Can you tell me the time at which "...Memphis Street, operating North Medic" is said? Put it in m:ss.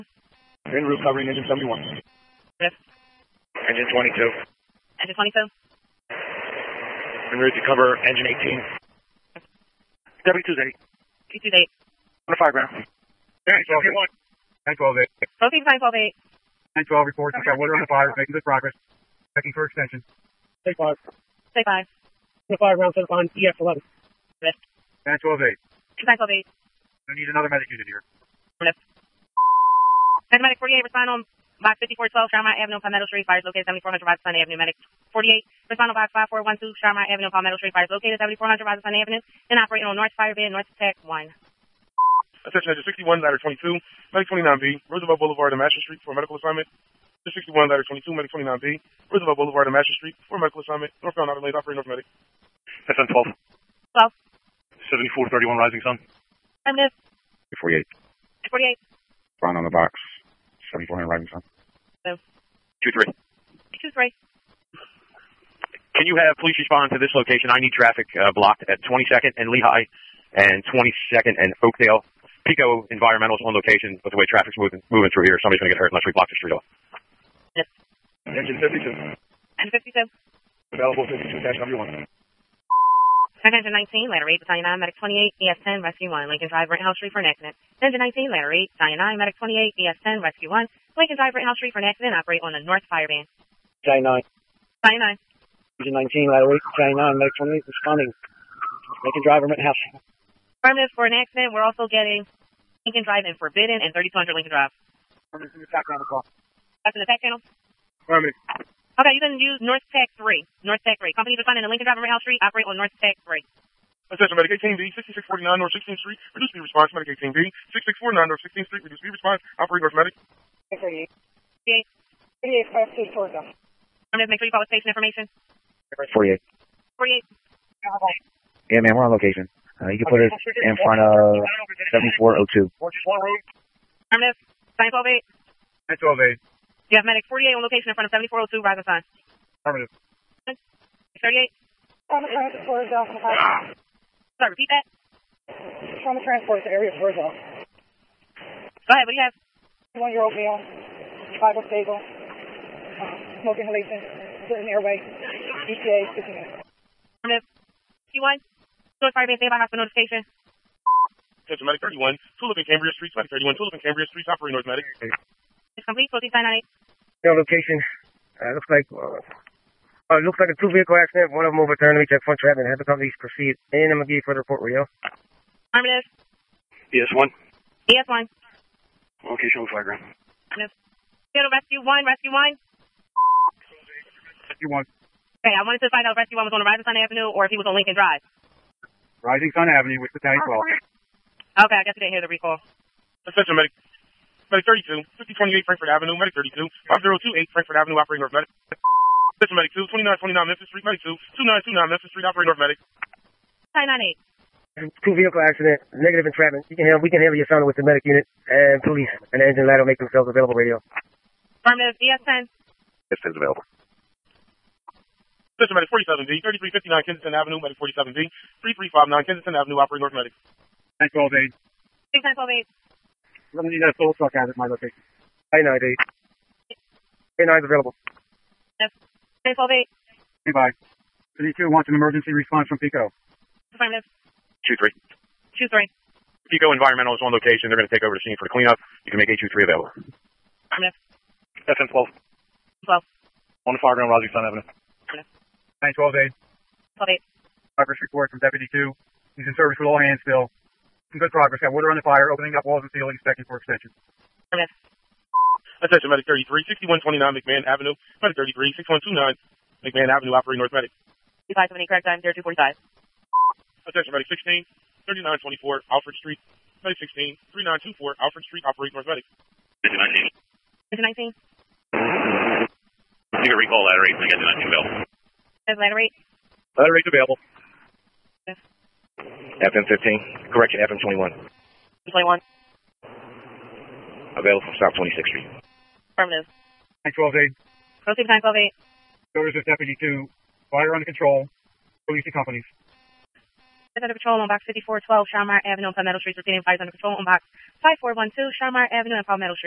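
3:21.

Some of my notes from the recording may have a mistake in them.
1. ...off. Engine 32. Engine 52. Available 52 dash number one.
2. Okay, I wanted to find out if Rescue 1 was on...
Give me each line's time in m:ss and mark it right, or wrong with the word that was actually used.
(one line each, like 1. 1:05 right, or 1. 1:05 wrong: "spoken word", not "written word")
1. 1:16 wrong: "52", not "32"
2. 3:05 right.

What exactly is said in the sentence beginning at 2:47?
Yeah, location, uh, looks like, uh, uh, looks like a two-vehicle accident, one of them overturned.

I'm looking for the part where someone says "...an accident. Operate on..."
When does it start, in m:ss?
1:31.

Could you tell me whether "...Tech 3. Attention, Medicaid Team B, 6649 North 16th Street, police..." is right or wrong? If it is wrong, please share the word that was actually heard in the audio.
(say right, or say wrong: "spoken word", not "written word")
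wrong: "reduce", not "police".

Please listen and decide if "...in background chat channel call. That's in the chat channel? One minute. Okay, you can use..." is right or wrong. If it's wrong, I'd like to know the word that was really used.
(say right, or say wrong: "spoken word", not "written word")
right.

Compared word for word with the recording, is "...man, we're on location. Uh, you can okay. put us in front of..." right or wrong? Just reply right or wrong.
right.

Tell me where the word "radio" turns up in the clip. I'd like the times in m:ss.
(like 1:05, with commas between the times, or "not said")
2:54, 3:30.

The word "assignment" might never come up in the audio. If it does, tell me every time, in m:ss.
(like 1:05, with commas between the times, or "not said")
0:46, 0:50.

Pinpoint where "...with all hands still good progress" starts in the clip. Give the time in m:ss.
4:09.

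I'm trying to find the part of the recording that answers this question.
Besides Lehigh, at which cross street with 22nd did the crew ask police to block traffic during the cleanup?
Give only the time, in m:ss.
1:10.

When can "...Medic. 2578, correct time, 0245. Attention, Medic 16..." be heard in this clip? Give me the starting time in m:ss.
4:20.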